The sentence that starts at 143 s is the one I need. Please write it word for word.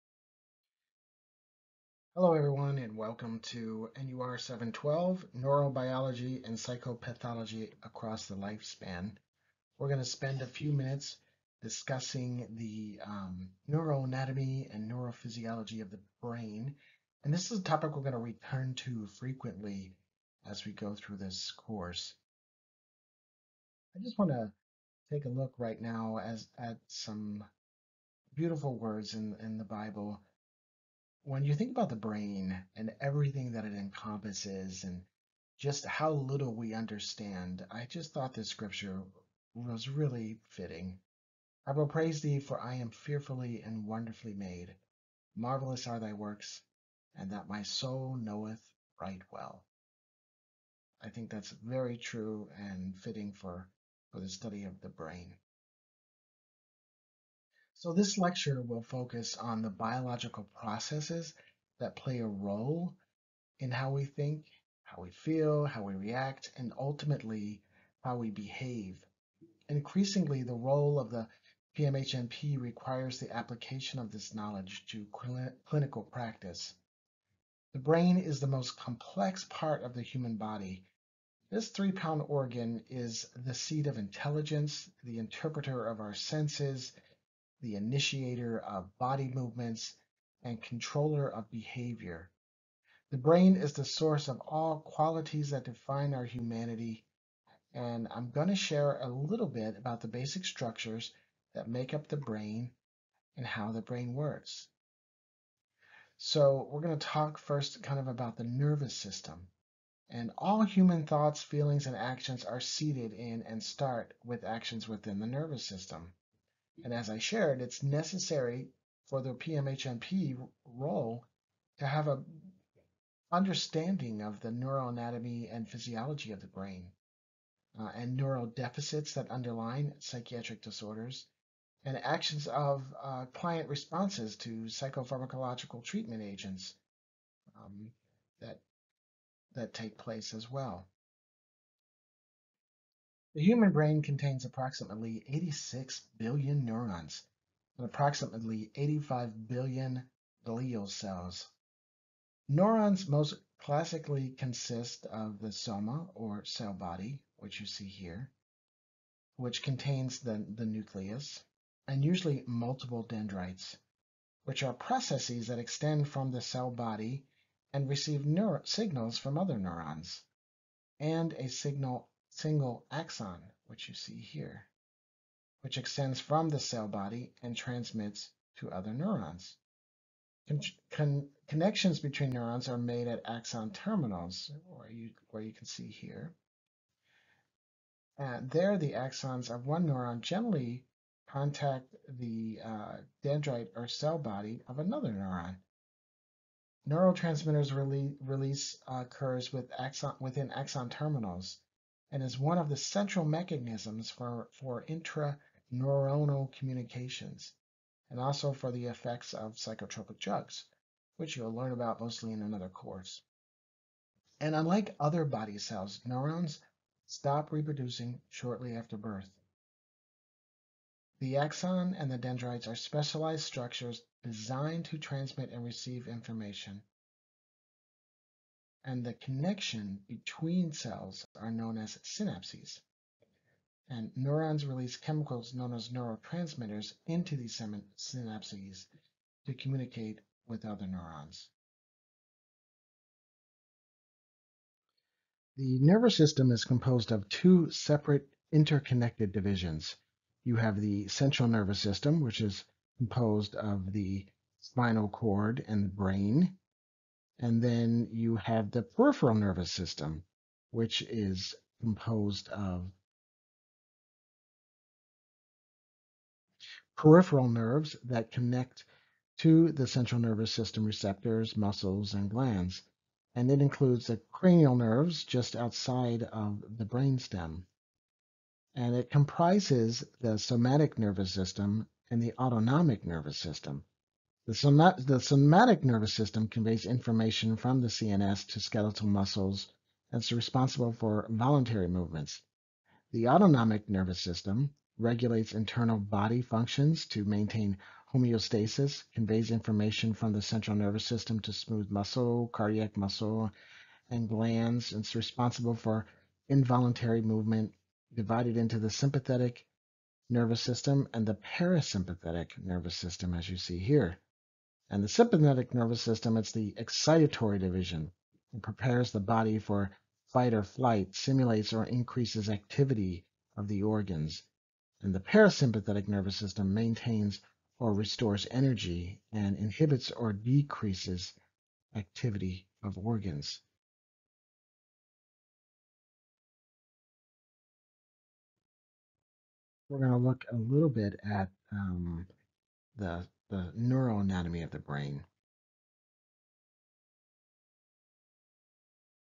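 The human brain contains approximately 86 billion neurons and approximately 85 billion glial cells.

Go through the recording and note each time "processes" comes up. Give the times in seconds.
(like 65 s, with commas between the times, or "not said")
60 s, 164 s.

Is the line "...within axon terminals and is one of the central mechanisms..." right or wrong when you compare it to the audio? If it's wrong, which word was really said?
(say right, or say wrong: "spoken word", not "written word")
right.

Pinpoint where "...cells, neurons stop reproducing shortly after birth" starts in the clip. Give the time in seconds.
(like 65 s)
215 s.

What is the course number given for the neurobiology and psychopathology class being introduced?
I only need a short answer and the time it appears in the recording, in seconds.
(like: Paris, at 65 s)
NUR 712, at 4 s.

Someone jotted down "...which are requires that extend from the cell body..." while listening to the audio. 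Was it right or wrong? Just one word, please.
wrong.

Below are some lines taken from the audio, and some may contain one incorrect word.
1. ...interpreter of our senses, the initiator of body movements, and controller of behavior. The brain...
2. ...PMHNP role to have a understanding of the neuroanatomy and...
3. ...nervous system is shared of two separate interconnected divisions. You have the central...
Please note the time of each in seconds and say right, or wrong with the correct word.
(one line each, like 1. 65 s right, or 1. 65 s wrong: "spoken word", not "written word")
1. 85 s right
2. 119 s right
3. 245 s wrong: "composed", not "shared".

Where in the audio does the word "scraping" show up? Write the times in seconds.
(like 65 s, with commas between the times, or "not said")
not said.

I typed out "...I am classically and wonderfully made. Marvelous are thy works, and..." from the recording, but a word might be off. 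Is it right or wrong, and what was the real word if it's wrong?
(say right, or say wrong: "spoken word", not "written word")
wrong: "fearfully", not "classically".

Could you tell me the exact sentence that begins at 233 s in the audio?
And neurons release chemicals known as neurotransmitters into these synapses to communicate with other neurons.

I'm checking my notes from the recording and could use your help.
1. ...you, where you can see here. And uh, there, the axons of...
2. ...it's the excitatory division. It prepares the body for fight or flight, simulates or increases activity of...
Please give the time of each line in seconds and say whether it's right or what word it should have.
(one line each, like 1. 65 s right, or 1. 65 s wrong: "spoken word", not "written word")
1. 184 s right
2. 316 s right.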